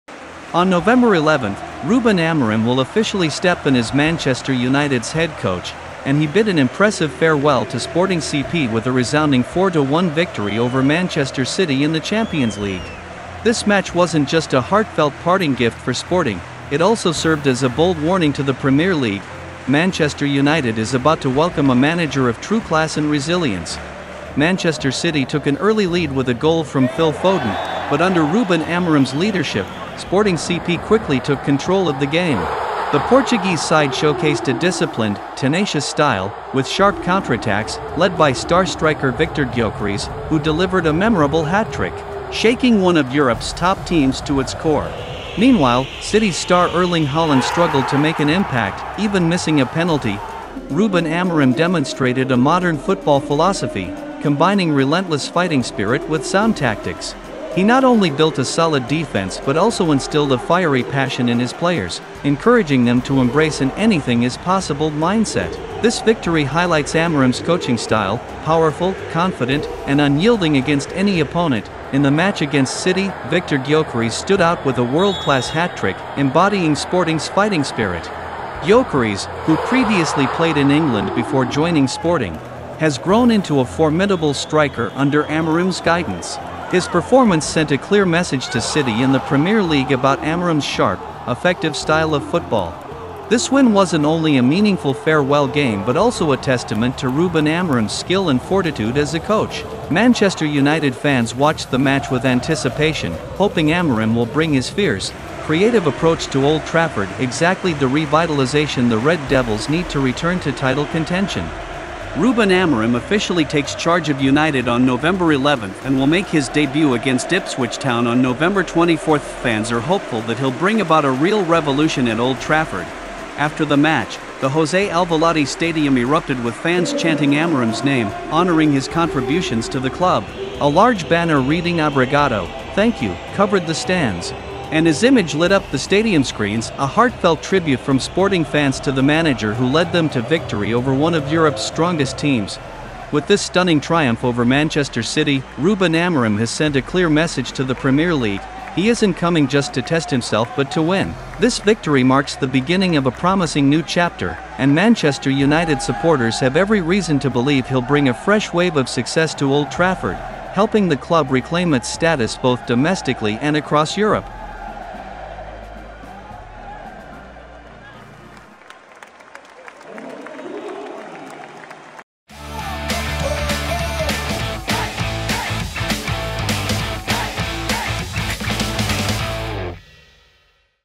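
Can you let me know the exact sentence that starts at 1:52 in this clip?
Ruben Amorim officially takes charge of United on November 11th and will make his debut against Ipswich Town on November 24th.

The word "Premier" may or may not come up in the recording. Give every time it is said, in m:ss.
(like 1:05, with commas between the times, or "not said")
0:18, 1:29, 2:27.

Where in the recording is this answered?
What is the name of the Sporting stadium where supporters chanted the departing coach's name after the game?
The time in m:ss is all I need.
2:04.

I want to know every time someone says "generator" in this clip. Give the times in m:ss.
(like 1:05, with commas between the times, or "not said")
not said.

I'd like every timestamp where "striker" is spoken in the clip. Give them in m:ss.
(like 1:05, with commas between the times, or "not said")
0:38, 1:24.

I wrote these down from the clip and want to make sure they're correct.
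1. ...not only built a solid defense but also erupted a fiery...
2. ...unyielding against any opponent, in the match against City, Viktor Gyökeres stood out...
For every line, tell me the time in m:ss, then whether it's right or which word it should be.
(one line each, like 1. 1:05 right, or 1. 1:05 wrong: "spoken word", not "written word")
1. 0:57 wrong: "instilled", not "erupted"
2. 1:09 right.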